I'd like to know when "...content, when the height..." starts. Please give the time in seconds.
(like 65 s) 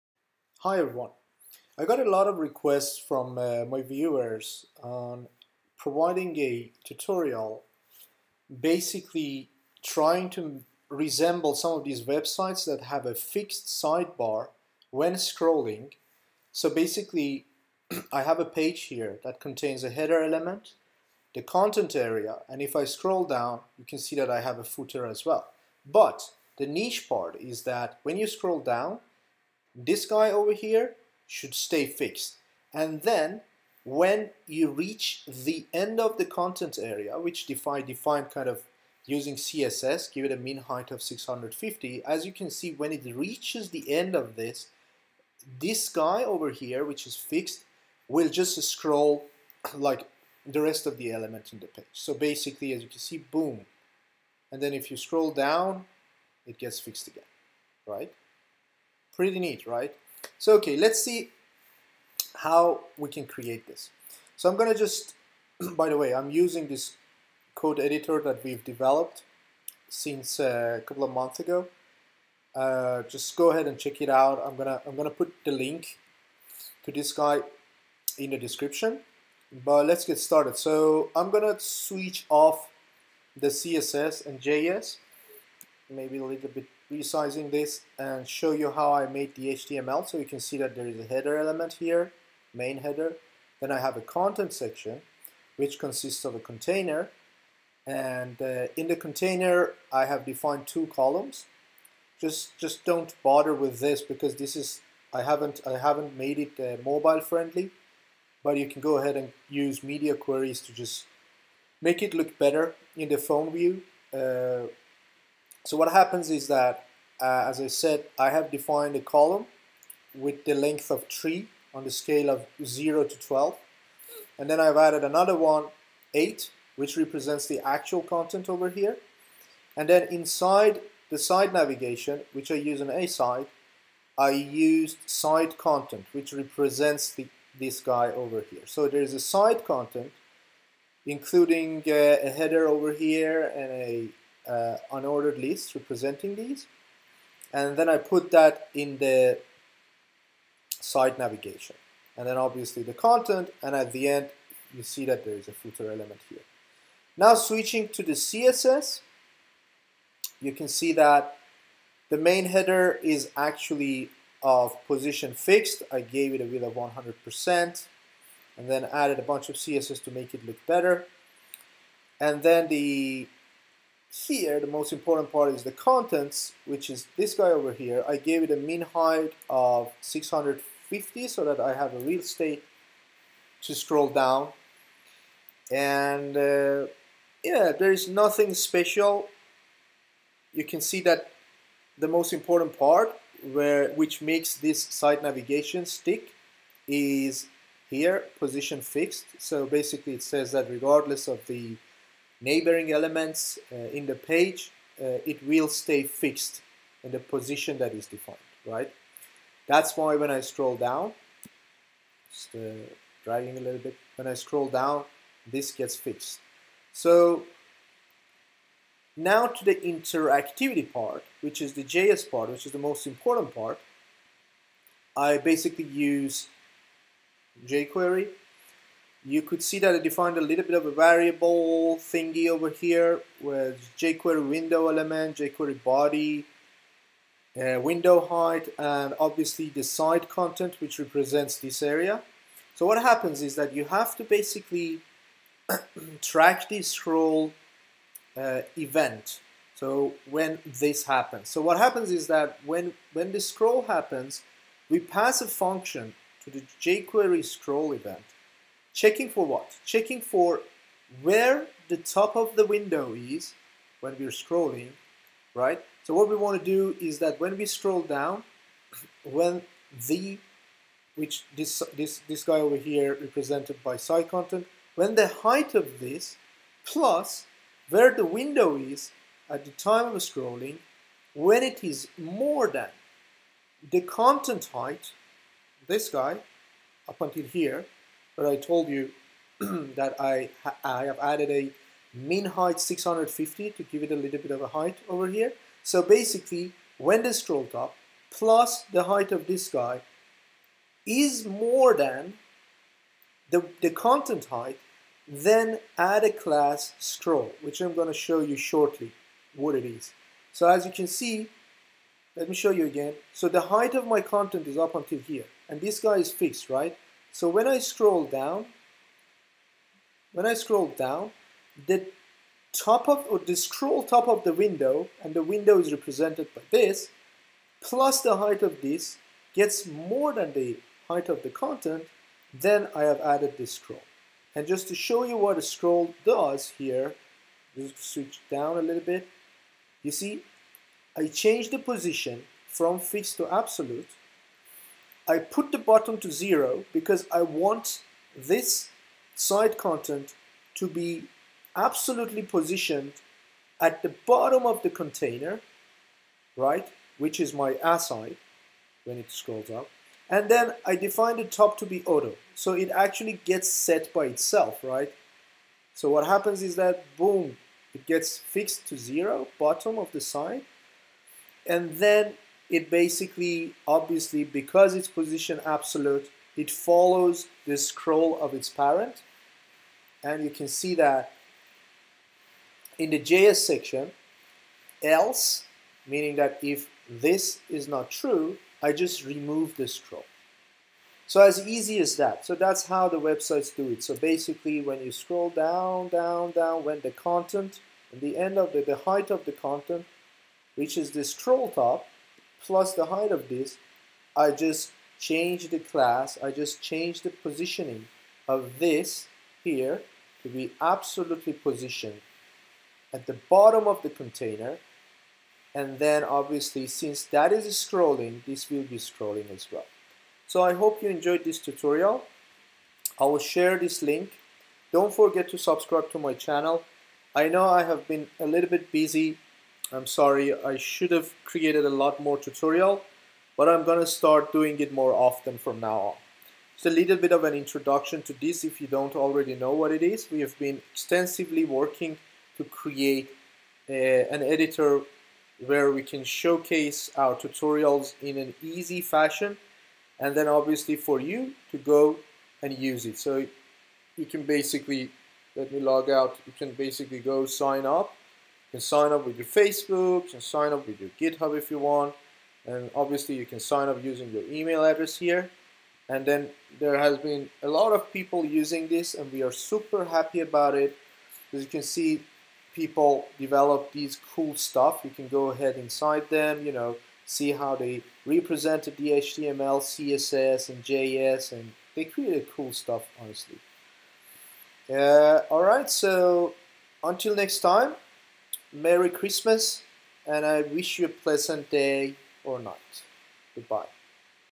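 274 s.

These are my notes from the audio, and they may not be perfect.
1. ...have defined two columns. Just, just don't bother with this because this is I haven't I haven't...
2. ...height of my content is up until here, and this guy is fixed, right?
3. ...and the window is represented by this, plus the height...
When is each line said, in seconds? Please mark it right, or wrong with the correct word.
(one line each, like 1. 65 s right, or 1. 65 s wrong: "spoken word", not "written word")
1. 100 s right
2. 313 s right
3. 325 s right.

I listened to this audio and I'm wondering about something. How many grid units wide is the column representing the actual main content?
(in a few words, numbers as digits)
8.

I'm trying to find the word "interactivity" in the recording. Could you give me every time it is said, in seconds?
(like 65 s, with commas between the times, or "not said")
219 s.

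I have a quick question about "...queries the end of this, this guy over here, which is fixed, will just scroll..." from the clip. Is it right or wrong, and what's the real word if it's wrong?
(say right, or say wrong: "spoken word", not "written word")
wrong: "reaches", not "queries".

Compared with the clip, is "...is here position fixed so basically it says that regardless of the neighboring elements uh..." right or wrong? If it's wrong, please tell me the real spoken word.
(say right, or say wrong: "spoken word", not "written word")
right.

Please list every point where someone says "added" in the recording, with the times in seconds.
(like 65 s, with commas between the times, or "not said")
124 s, 168 s, 291 s, 333 s.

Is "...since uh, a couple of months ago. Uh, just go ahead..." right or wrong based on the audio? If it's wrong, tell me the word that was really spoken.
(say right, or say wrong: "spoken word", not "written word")
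right.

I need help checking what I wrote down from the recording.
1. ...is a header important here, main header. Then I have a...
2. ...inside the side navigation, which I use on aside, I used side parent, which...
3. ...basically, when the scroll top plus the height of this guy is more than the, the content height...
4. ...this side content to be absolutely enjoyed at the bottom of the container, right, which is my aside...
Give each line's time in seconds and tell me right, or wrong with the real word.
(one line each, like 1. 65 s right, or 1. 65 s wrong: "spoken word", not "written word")
1. 90 s wrong: "element", not "important"
2. 130 s wrong: "content", not "parent"
3. 296 s right
4. 348 s wrong: "positioned", not "enjoyed".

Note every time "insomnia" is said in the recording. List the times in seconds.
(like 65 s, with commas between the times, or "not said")
not said.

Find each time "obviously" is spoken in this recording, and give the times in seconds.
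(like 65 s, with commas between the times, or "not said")
152 s, 239 s, 373 s, 416 s, 450 s, 462 s.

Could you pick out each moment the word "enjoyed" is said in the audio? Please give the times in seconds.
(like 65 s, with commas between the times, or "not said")
421 s.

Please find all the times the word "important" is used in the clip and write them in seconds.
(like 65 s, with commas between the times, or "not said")
174 s, 192 s, 223 s.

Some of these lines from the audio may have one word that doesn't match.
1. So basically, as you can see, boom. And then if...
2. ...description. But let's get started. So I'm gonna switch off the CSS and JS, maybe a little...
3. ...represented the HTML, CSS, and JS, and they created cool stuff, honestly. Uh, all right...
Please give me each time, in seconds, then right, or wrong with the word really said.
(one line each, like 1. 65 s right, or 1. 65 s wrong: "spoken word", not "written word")
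1. 51 s right
2. 78 s right
3. 478 s right.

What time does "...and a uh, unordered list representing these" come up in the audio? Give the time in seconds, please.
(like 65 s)
143 s.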